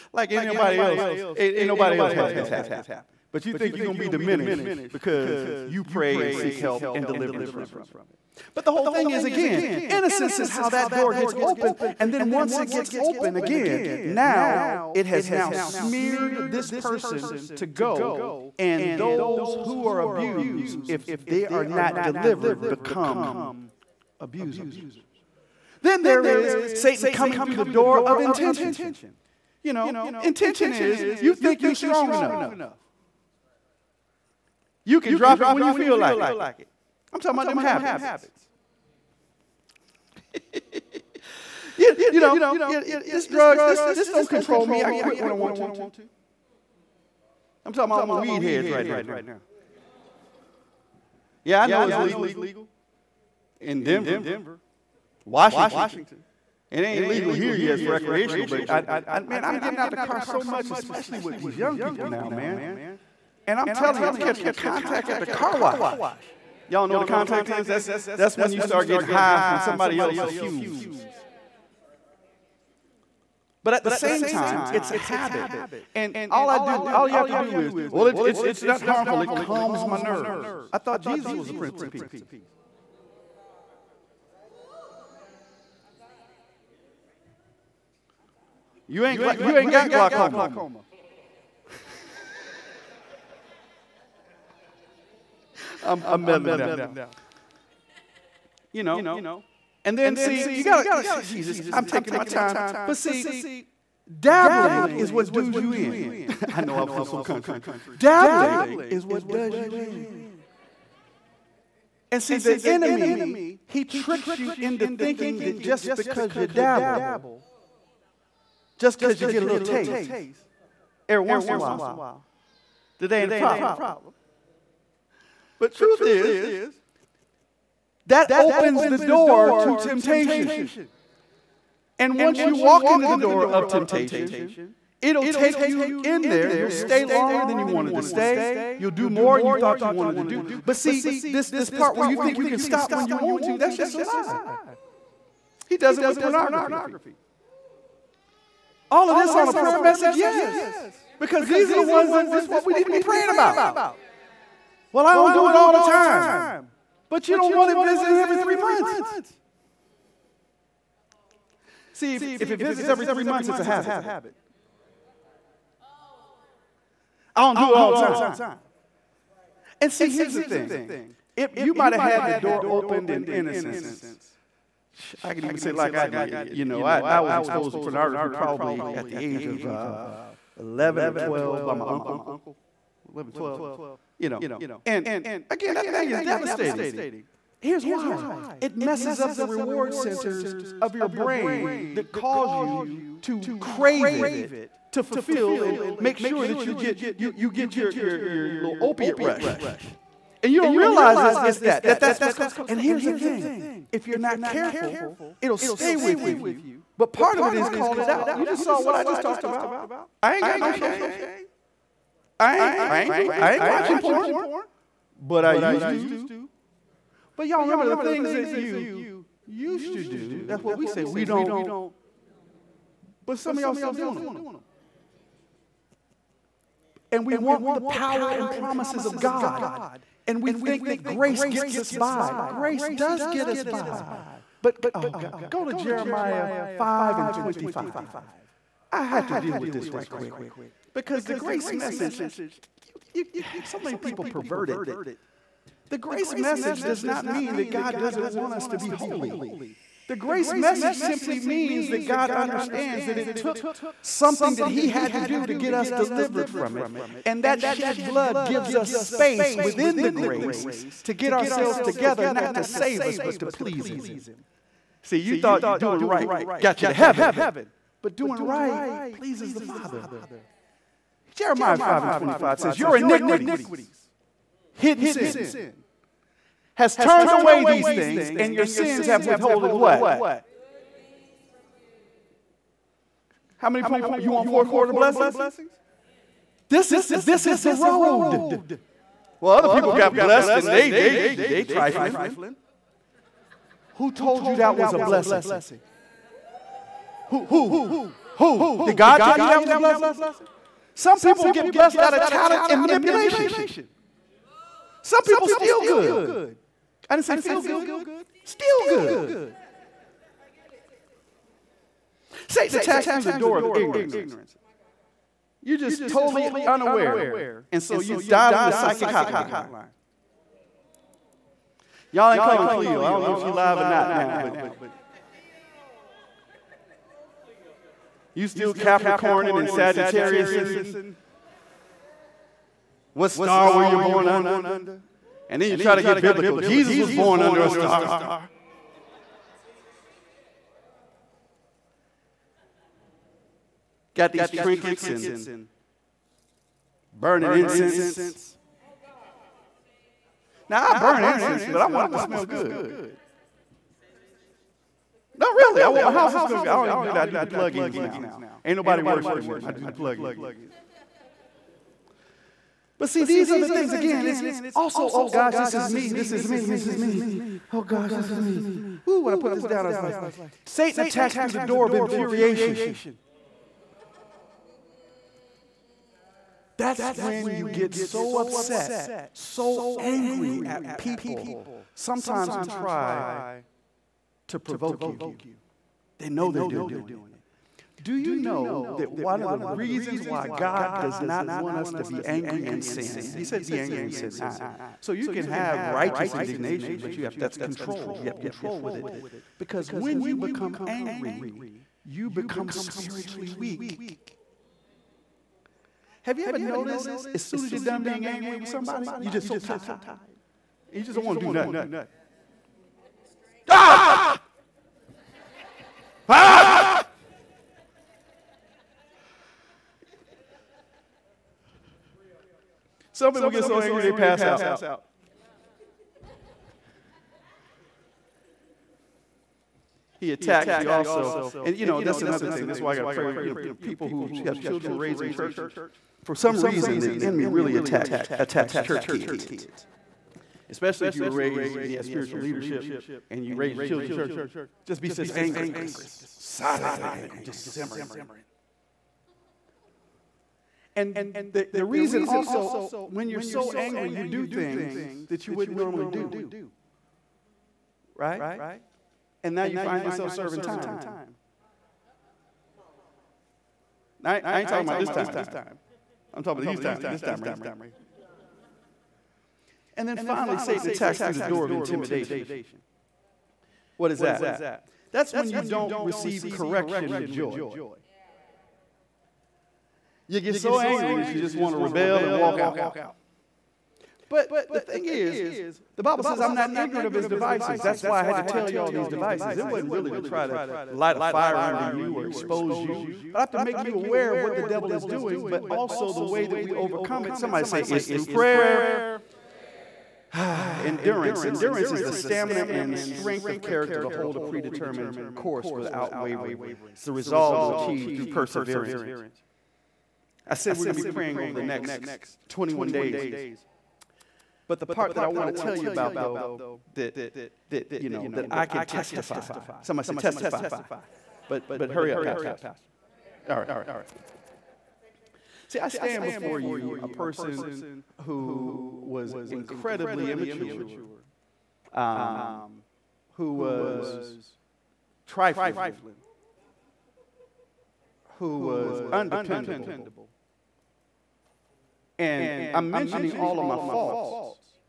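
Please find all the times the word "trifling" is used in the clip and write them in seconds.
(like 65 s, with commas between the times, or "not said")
291 s, 535 s.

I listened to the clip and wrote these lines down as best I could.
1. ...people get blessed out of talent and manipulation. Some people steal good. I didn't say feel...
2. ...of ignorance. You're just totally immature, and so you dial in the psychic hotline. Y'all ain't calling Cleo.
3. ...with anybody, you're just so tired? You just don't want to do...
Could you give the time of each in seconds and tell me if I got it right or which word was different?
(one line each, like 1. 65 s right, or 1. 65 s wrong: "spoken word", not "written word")
1. 301 s right
2. 313 s wrong: "unaware", not "immature"
3. 408 s wrong: "somebody", not "anybody".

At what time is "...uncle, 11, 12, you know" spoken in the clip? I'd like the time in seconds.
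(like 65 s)
181 s.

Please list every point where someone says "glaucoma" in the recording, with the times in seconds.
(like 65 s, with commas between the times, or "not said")
89 s.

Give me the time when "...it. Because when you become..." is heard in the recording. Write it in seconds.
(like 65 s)
398 s.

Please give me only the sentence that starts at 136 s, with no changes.
You'll stay longer than you wanted to stay.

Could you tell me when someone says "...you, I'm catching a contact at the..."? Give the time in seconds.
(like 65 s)
64 s.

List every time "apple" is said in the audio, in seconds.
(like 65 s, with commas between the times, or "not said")
not said.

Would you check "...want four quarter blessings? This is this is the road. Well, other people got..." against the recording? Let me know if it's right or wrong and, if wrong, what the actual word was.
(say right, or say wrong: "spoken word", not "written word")
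right.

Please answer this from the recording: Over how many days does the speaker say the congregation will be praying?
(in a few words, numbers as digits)
21.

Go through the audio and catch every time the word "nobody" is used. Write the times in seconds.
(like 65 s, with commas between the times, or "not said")
1 s, 358 s.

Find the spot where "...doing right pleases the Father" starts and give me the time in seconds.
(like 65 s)
268 s.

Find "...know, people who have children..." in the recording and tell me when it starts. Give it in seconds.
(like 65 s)
433 s.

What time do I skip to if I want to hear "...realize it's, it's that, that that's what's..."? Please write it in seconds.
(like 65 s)
200 s.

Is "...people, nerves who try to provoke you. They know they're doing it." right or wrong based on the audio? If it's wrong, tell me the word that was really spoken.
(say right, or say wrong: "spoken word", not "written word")
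wrong: "sometimes", not "nerves".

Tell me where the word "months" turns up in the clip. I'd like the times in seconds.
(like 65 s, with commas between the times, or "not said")
158 s, 163 s.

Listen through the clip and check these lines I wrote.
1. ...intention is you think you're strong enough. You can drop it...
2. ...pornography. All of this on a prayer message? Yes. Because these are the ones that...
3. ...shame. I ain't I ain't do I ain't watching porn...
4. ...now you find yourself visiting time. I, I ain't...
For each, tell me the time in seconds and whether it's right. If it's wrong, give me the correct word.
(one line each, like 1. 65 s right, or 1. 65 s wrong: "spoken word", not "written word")
1. 30 s right
2. 146 s right
3. 210 s right
4. 459 s wrong: "serving", not "visiting".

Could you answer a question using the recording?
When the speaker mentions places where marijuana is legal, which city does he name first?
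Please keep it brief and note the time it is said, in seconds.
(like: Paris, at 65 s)
Denver, at 53 s.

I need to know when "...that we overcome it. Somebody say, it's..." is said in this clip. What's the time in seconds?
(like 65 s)
496 s.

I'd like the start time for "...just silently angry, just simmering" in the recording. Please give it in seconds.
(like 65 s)
445 s.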